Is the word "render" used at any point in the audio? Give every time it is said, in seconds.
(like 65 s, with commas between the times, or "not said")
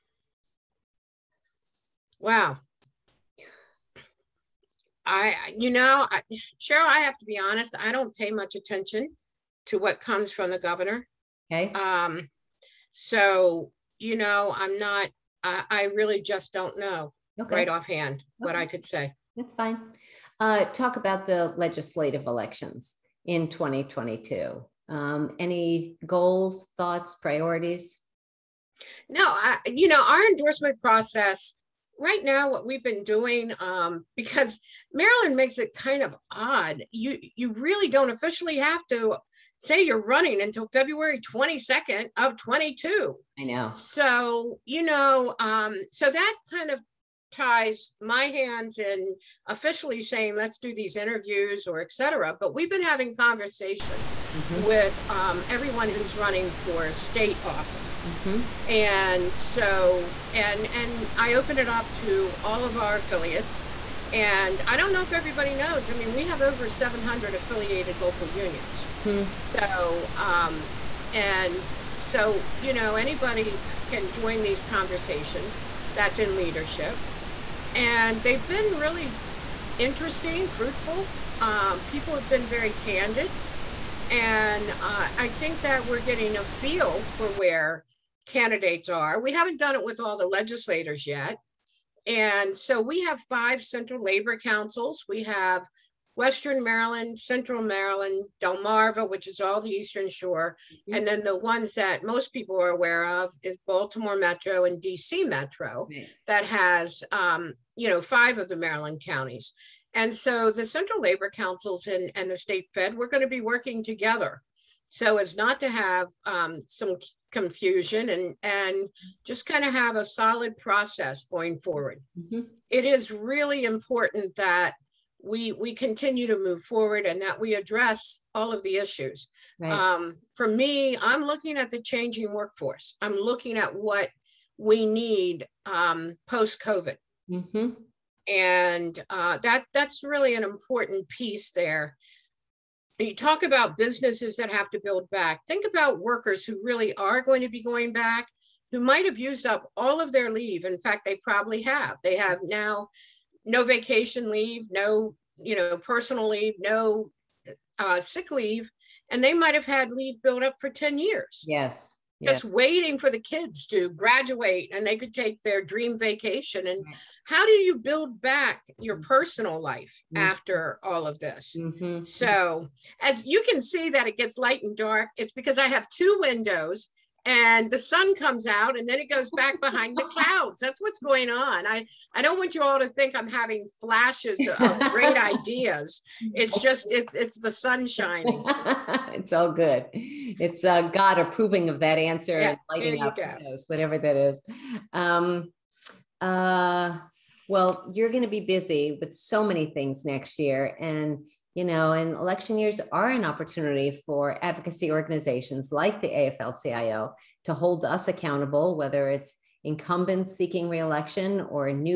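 not said.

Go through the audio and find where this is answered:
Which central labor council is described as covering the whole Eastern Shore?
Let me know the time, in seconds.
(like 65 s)
98 s.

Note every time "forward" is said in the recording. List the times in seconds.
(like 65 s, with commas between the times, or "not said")
121 s, 126 s.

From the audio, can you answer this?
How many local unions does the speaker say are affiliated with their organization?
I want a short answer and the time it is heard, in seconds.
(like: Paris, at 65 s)
over 700, at 66 s.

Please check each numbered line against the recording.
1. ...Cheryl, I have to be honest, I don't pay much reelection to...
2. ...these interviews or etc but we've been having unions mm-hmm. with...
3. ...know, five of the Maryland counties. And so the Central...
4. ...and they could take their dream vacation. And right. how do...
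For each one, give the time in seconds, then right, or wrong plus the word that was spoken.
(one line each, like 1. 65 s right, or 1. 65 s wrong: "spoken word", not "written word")
1. 6 s wrong: "attention", not "reelection"
2. 50 s wrong: "conversations", not "unions"
3. 107 s right
4. 164 s right.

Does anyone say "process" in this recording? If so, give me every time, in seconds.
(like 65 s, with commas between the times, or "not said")
30 s, 120 s.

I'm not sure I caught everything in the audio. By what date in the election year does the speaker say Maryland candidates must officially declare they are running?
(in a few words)
February 22.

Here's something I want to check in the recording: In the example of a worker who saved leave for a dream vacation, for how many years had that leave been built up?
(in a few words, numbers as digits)
10 years.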